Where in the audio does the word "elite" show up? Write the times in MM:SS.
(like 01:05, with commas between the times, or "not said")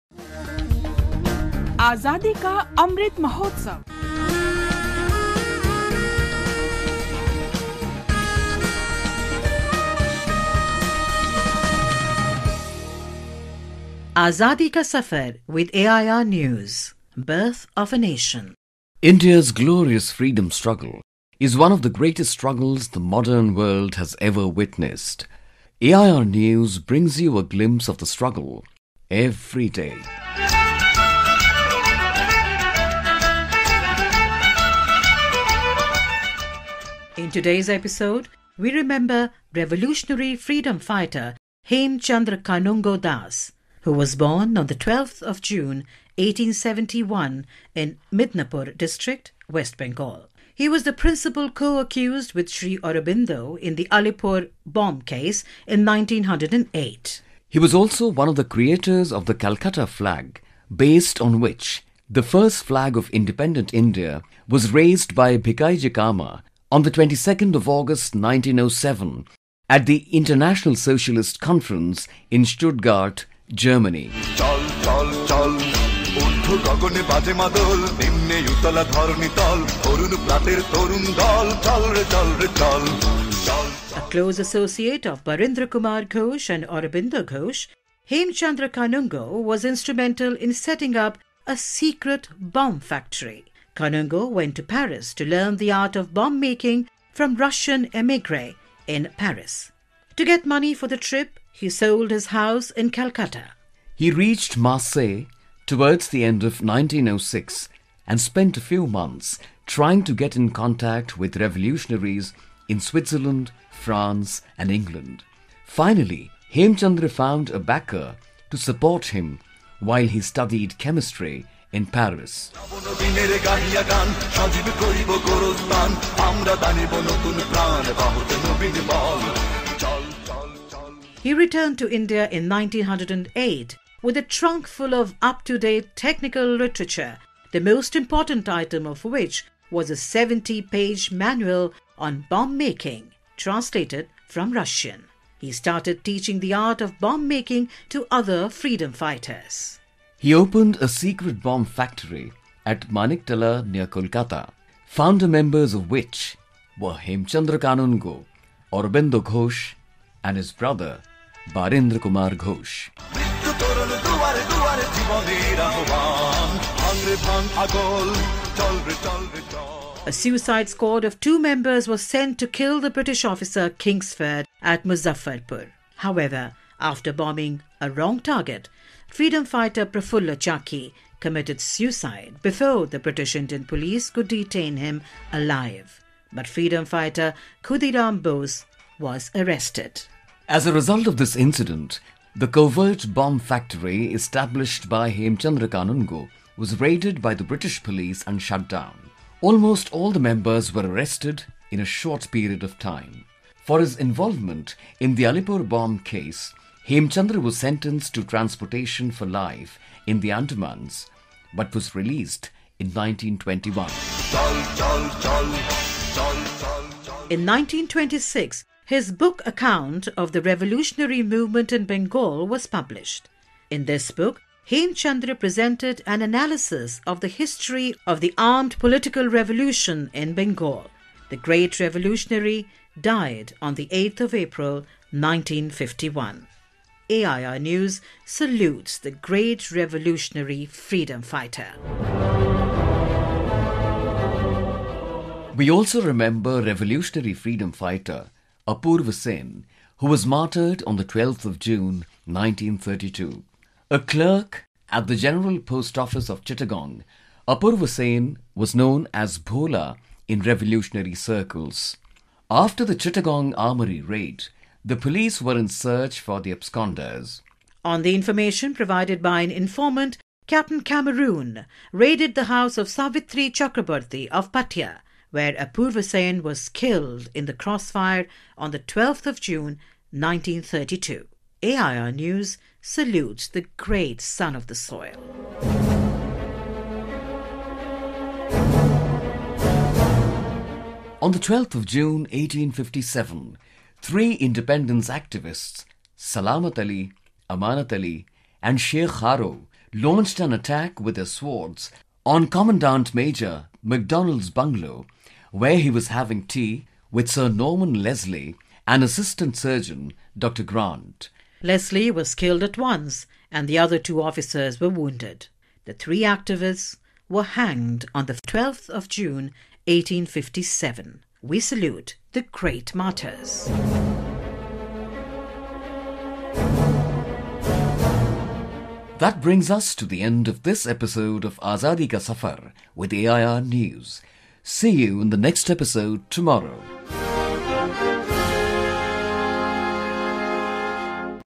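not said.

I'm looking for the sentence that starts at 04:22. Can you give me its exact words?
After the Chittagong Armory raid, the police were in search for the absconders.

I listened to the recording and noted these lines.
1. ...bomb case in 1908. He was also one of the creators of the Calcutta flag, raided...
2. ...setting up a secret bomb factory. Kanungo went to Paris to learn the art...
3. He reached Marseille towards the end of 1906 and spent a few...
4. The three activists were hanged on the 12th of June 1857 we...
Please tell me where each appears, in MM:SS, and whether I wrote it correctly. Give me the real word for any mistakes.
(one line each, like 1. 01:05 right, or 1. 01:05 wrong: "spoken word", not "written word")
1. 00:54 wrong: "based", not "raided"
2. 01:30 right
3. 01:43 right
4. 05:15 right.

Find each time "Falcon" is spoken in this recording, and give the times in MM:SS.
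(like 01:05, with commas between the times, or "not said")
not said.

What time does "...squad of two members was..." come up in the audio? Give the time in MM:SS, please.
02:50.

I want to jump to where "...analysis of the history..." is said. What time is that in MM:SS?
03:46.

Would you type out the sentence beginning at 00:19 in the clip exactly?
India's glorious freedom struggle is one of the greatest struggles the modern world has ever witnessed.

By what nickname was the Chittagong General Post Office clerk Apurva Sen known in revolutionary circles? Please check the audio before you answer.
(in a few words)
Bhola.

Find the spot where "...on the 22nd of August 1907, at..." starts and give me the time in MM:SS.
01:06.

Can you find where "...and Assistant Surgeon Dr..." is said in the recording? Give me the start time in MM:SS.
05:08.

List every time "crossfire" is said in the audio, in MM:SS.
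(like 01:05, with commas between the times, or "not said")
04:37.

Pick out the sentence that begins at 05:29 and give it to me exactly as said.
That brings us to the end of this episode of Azadi Ka Safar with AIR News.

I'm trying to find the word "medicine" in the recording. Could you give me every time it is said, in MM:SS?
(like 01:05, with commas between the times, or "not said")
not said.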